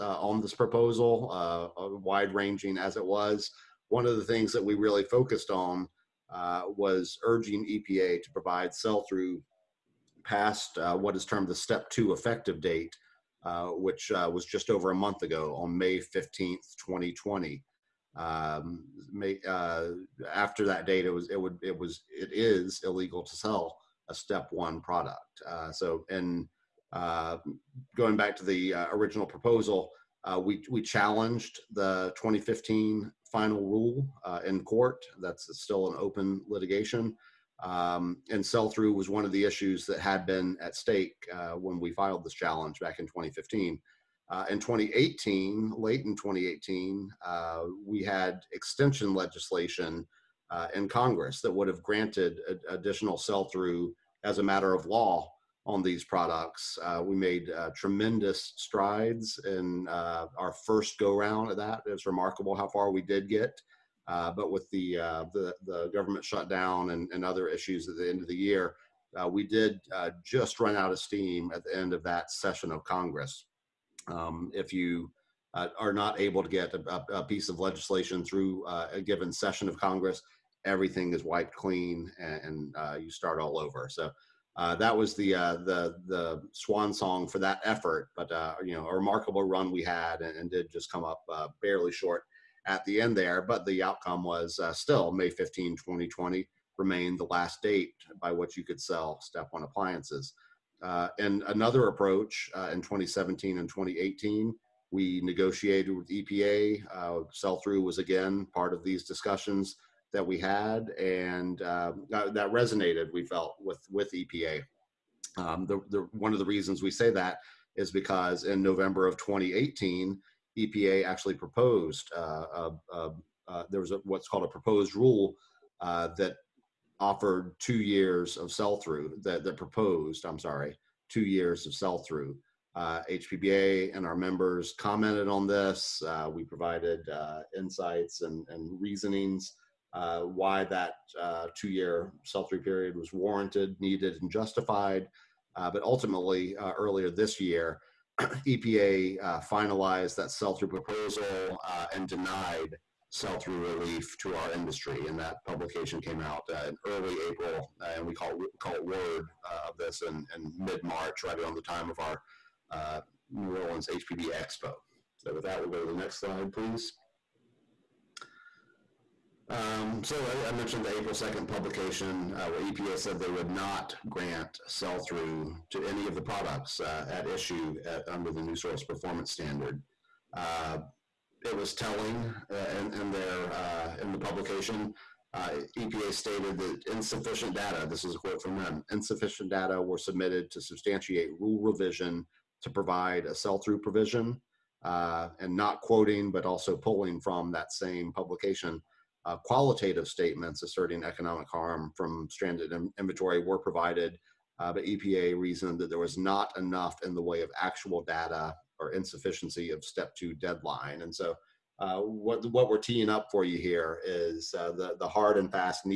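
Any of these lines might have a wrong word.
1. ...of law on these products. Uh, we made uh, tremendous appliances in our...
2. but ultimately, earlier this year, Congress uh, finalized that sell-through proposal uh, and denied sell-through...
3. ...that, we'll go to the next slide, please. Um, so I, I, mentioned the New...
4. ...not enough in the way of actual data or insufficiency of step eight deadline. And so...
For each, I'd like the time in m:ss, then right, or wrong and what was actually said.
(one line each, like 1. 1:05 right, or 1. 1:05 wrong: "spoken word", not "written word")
1. 0:54 wrong: "strides", not "appliances"
2. 2:25 wrong: "EPA", not "Congress"
3. 2:45 wrong: "April", not "New"
4. 3:26 wrong: "two", not "eight".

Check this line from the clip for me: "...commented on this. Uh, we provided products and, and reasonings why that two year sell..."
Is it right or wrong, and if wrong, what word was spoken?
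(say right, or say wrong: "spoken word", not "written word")
wrong: "insights", not "products".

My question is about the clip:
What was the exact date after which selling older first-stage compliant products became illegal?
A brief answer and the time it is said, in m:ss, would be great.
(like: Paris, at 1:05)
May 15th, 2020, at 0:15.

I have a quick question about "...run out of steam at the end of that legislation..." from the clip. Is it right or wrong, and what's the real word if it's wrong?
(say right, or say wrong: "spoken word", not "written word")
wrong: "session", not "legislation".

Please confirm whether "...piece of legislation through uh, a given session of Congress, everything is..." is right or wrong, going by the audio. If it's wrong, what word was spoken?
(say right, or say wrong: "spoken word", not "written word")
right.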